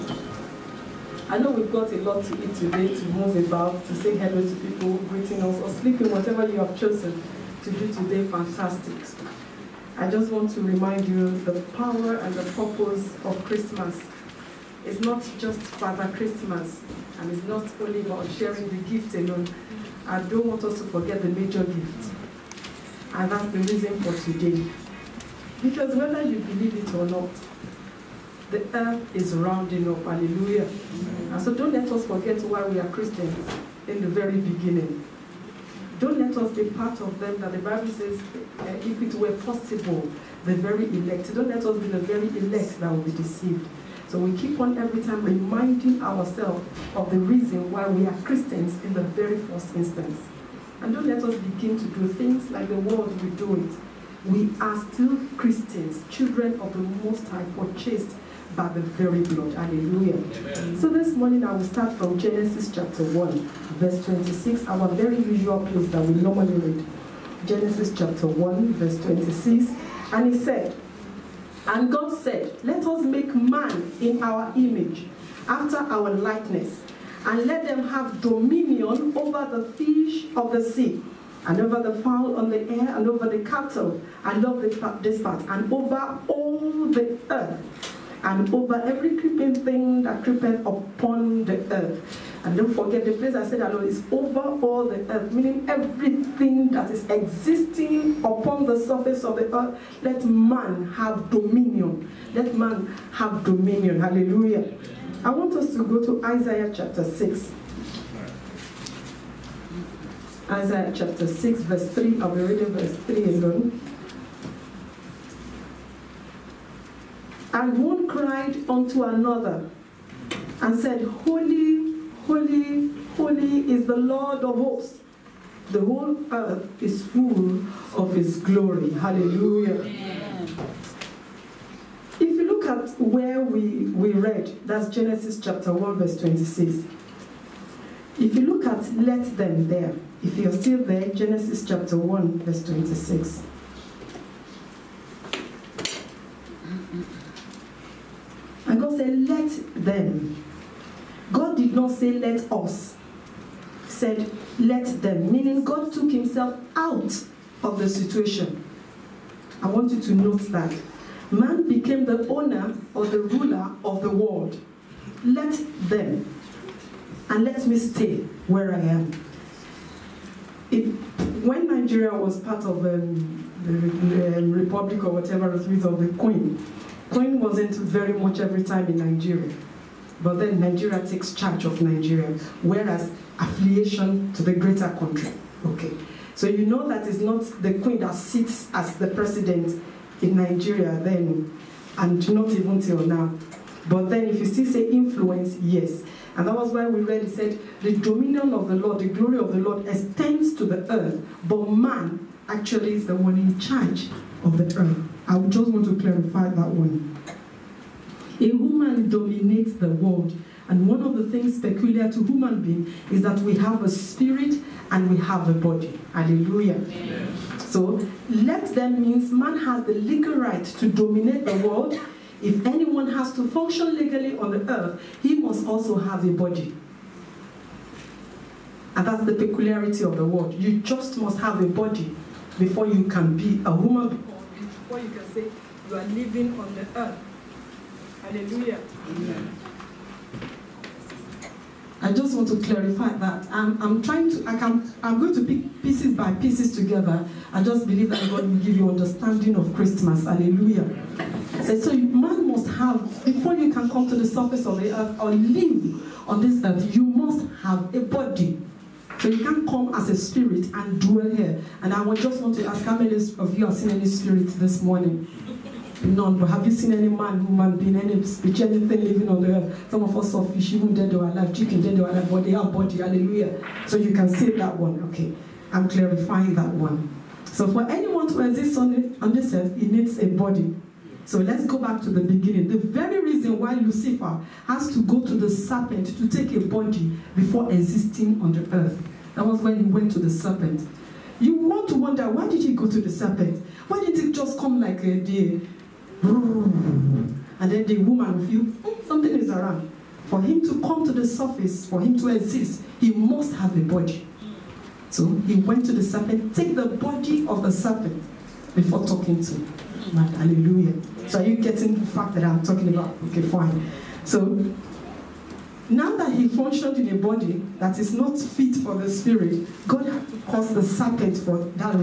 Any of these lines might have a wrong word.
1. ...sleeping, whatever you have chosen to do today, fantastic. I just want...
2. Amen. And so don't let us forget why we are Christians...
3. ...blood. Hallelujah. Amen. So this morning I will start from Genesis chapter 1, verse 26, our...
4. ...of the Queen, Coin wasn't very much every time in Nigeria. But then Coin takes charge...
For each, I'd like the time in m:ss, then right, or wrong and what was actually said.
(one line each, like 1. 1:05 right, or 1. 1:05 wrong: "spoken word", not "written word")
1. 0:05 right
2. 0:30 right
3. 0:59 right
4. 2:55 wrong: "Nigeria", not "Coin".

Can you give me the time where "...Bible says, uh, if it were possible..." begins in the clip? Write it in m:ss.
0:37.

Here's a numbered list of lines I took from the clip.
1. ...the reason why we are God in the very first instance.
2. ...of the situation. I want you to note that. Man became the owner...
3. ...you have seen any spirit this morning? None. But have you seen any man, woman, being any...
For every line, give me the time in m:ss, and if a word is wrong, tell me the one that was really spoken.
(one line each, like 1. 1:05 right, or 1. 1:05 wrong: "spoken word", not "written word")
1. 0:47 wrong: "Christians", not "God"
2. 2:37 right
3. 4:23 right.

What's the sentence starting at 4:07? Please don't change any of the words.
I just believe that God will give you understanding of Christmas.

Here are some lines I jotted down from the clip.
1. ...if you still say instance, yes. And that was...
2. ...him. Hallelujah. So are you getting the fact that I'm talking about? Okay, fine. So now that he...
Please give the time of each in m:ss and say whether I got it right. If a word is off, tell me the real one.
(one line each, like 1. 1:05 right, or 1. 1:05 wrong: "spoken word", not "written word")
1. 3:14 wrong: "influence", not "instance"
2. 5:09 right.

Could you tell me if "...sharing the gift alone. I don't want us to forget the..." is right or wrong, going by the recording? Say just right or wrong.
right.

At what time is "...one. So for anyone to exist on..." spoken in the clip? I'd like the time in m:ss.
4:36.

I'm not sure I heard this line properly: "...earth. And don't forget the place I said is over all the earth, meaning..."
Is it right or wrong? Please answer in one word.
right.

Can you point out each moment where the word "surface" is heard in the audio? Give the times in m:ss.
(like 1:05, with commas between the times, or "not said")
1:38, 4:14, 5:01.